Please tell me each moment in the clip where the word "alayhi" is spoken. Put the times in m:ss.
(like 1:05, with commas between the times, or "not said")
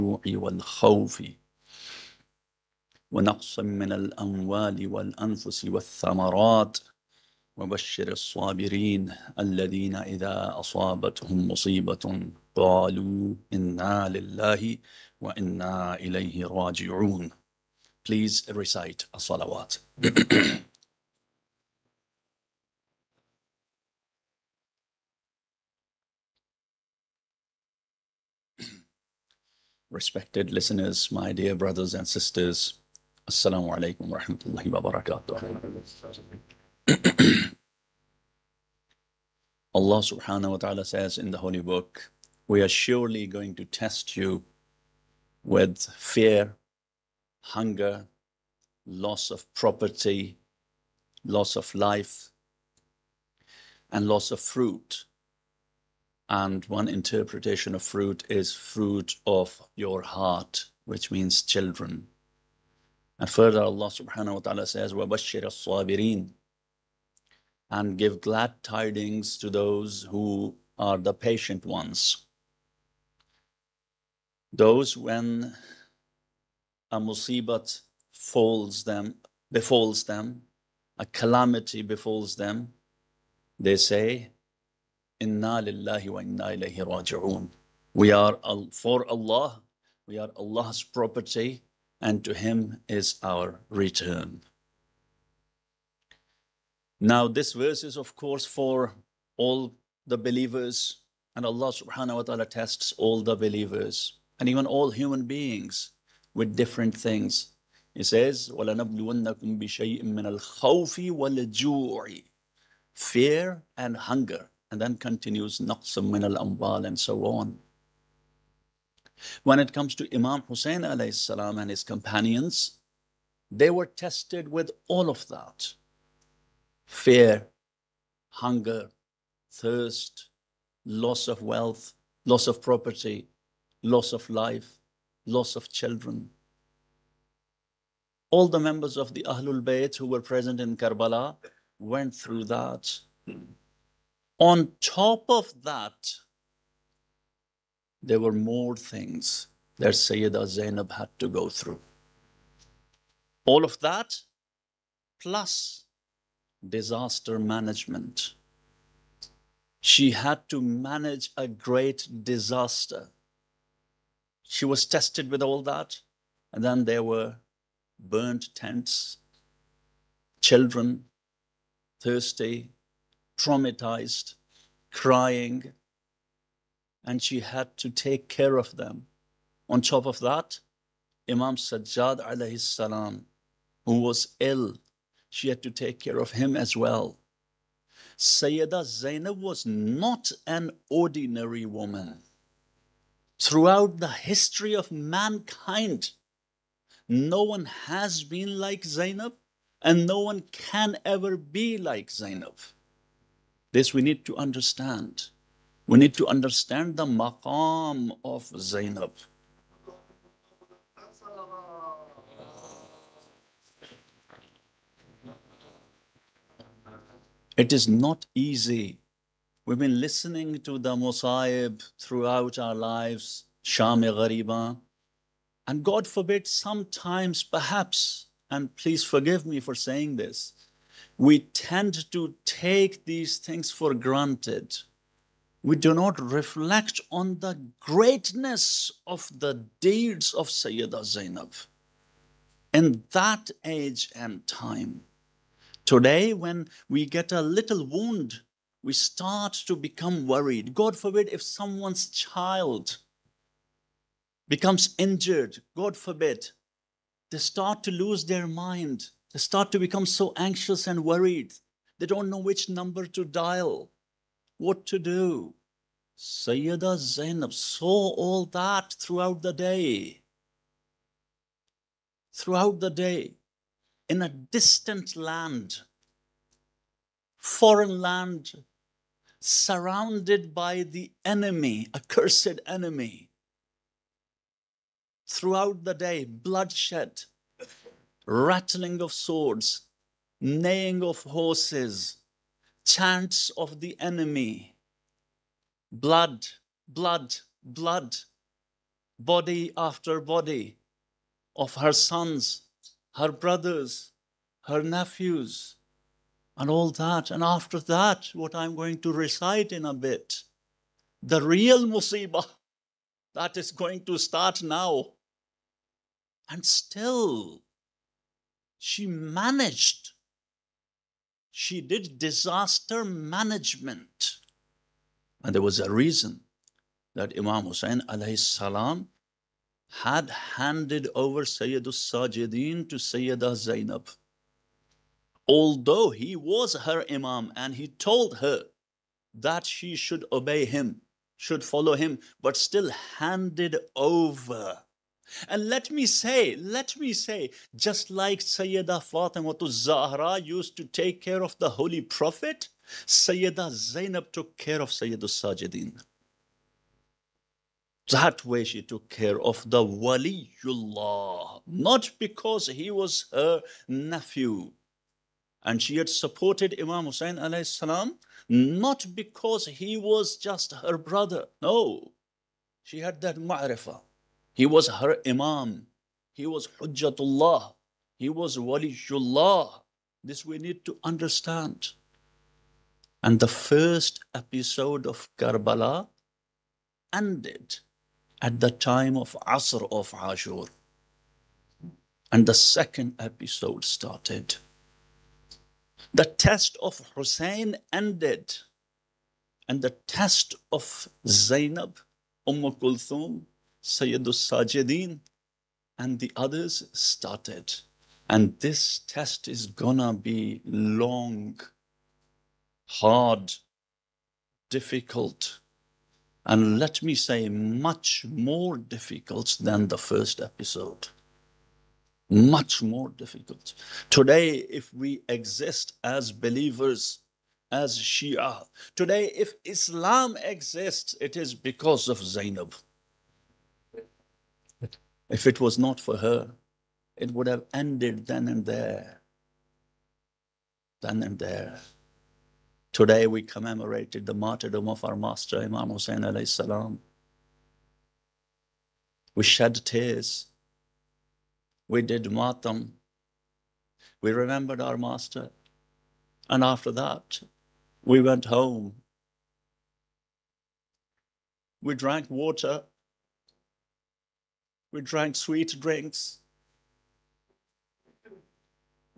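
2:00, 5:28, 6:07, 7:26.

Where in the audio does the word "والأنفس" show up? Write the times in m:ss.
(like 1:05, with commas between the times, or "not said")
0:04.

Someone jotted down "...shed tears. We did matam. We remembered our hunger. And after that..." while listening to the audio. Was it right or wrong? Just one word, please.
wrong.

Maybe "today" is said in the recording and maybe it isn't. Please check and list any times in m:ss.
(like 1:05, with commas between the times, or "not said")
4:05, 7:04, 7:08, 7:22.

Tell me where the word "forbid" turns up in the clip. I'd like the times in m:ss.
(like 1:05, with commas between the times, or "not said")
3:46, 4:10, 4:15.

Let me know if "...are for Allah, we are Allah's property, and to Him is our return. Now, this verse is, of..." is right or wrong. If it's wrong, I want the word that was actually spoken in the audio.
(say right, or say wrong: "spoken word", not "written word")
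right.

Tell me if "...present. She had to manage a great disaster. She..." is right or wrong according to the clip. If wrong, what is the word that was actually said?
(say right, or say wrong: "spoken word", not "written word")
wrong: "management", not "present".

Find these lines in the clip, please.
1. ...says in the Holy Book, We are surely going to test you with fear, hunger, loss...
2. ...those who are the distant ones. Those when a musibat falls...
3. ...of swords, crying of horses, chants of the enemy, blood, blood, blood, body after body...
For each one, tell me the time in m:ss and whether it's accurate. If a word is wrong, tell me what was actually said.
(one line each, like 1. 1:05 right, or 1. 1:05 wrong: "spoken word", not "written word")
1. 0:40 right
2. 1:09 wrong: "patient", not "distant"
3. 4:49 wrong: "neighing", not "crying".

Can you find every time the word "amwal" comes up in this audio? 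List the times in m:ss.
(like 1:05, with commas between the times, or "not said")
1:56.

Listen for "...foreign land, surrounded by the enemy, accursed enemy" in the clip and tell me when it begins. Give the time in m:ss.
4:37.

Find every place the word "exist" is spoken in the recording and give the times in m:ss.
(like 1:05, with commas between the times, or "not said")
7:05, 7:10.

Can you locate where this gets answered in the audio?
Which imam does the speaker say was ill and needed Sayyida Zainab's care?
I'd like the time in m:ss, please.
3:01.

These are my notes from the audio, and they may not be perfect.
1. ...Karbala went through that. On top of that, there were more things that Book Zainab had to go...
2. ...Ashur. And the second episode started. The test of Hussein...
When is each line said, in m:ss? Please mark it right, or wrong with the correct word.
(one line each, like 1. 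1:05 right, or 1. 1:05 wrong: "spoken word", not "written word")
1. 2:20 wrong: "Sayyida", not "Book"
2. 6:30 right.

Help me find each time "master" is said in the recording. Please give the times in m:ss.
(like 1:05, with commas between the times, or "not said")
7:25, 7:34.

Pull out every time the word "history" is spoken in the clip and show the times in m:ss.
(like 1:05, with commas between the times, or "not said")
3:14.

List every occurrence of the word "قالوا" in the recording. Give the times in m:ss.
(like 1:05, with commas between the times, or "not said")
0:12.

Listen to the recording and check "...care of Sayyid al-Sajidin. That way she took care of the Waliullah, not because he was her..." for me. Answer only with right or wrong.
right.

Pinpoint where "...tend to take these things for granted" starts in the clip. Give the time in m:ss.
3:51.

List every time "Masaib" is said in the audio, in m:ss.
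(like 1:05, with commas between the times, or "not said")
3:40.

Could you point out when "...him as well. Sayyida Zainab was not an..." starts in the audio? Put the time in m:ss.
3:06.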